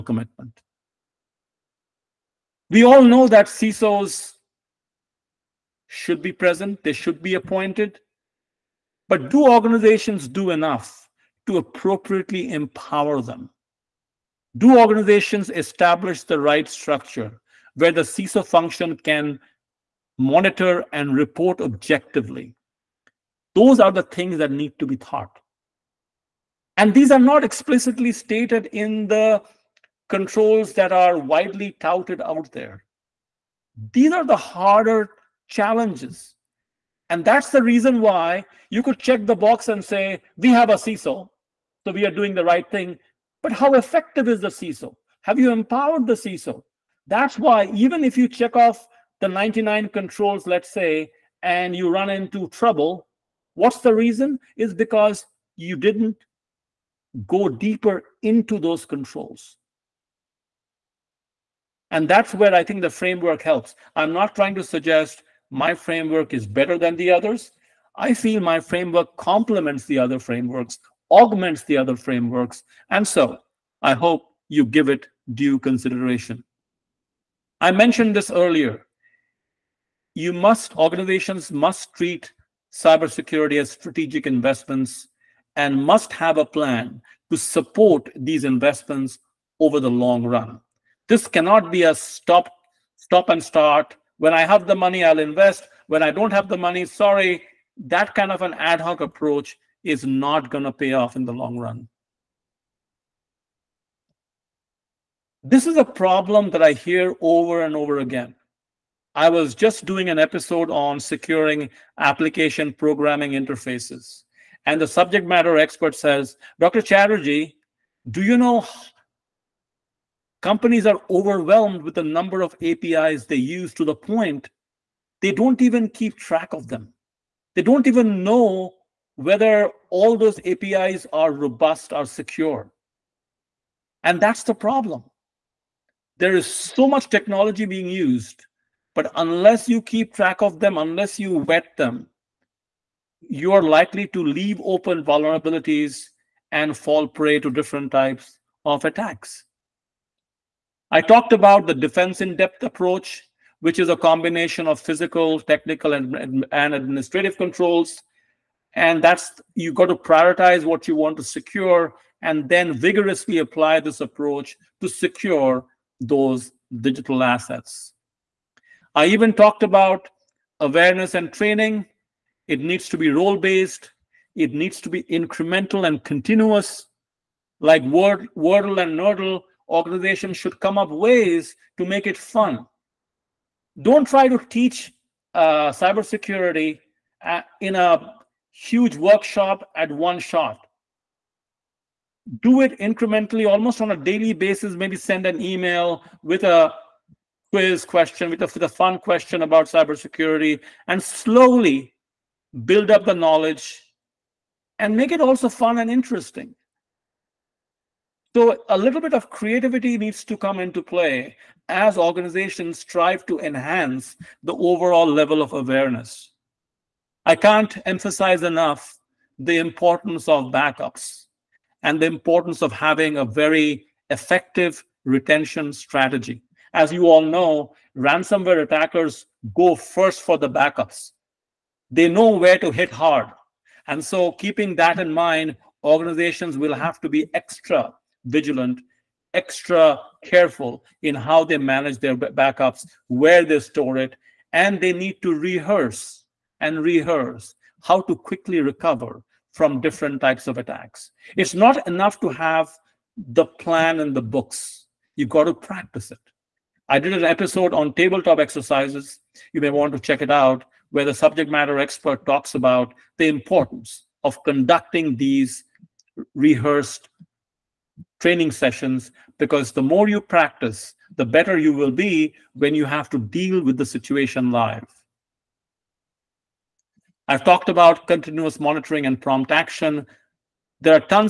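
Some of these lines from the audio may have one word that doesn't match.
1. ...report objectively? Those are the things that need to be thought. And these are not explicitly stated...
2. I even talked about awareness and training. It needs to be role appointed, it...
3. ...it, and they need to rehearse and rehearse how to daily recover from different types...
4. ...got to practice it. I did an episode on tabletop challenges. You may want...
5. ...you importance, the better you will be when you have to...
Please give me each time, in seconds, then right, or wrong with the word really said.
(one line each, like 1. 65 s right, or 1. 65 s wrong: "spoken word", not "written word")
1. 21 s right
2. 168 s wrong: "based", not "appointed"
3. 243 s wrong: "quickly", not "daily"
4. 255 s wrong: "exercises", not "challenges"
5. 270 s wrong: "practice", not "importance".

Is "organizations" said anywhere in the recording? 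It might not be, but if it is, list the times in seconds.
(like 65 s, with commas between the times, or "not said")
9 s, 14 s, 80 s, 179 s, 211 s, 235 s.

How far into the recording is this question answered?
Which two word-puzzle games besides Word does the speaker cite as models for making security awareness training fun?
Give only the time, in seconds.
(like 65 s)
178 s.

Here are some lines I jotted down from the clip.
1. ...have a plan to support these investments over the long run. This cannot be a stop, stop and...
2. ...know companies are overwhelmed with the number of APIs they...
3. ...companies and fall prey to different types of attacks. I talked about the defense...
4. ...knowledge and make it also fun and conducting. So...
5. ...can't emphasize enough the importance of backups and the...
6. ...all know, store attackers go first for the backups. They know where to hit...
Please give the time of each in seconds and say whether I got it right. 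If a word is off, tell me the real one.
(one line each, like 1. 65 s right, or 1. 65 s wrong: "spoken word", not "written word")
1. 86 s right
2. 118 s right
3. 145 s wrong: "vulnerabilities", not "companies"
4. 203 s wrong: "interesting", not "conducting"
5. 217 s right
6. 227 s wrong: "ransomware", not "store".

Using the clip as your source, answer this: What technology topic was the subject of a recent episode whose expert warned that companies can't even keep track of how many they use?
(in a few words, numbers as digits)
application programming interfaces.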